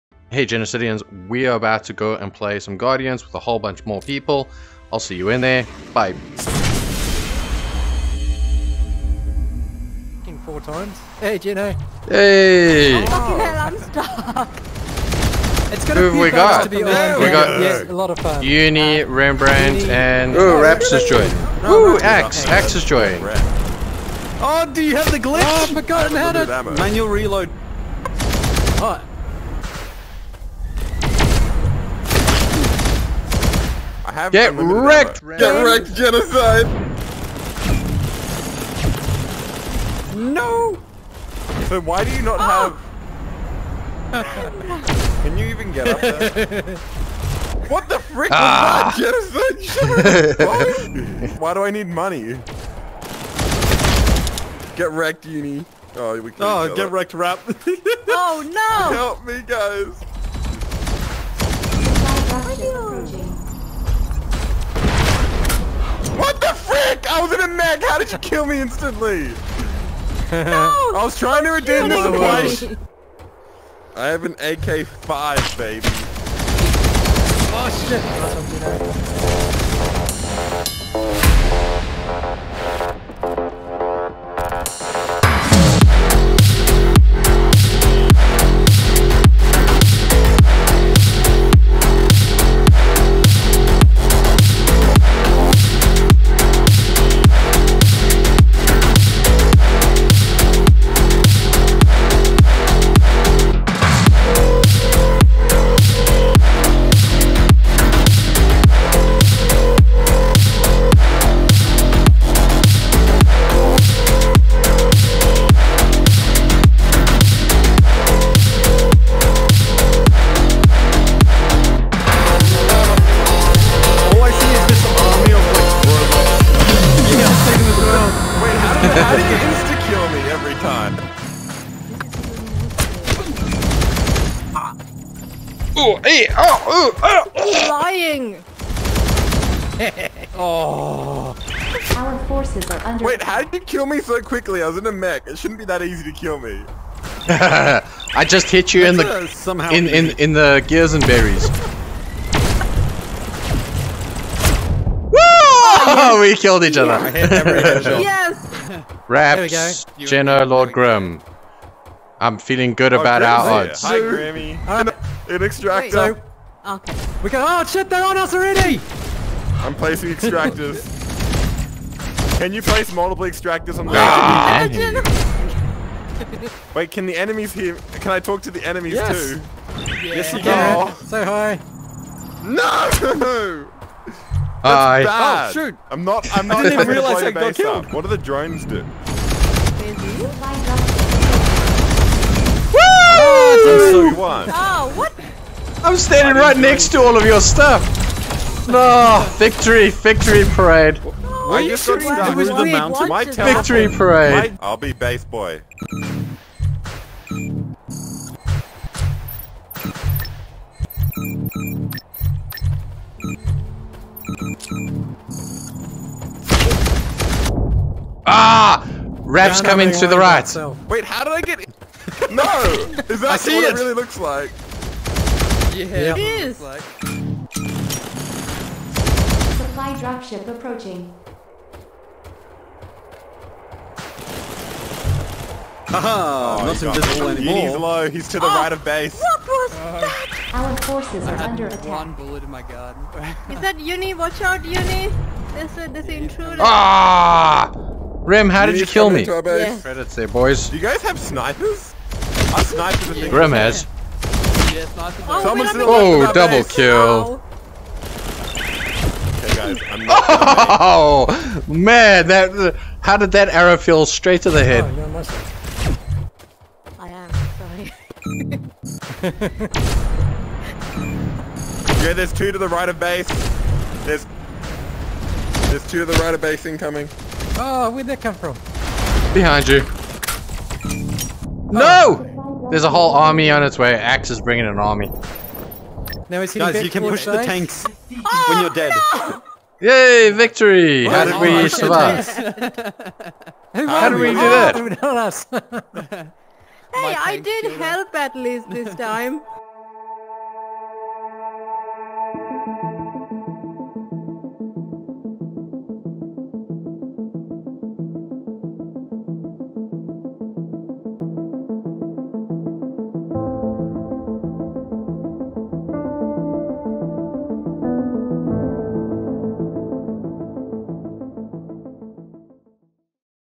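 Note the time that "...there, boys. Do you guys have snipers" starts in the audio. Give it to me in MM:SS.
04:10.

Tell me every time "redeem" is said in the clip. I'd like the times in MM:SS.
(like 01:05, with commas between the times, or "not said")
01:11.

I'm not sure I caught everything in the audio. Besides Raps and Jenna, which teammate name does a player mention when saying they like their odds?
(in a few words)
Lord Grim.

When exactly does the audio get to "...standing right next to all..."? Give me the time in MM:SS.
03:15.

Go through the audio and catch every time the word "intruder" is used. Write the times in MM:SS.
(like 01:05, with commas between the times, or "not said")
04:06.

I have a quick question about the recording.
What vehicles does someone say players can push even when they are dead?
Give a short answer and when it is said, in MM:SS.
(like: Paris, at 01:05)
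tanks, at 04:47.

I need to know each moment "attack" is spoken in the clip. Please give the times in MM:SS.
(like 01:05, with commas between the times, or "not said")
04:01.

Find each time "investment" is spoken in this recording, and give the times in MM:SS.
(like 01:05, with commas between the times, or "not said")
not said.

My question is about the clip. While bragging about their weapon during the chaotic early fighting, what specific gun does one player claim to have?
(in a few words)
AK-5.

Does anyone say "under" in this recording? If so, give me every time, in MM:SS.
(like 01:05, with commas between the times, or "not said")
02:22, 04:01.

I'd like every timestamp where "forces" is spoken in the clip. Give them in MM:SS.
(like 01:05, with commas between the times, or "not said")
02:22, 04:00.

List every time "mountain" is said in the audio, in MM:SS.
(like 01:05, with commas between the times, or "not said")
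03:22.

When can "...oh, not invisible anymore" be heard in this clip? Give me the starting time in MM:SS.
03:56.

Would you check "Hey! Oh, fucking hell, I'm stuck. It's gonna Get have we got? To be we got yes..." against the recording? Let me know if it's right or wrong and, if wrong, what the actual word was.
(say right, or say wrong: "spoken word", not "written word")
wrong: "Who", not "Get".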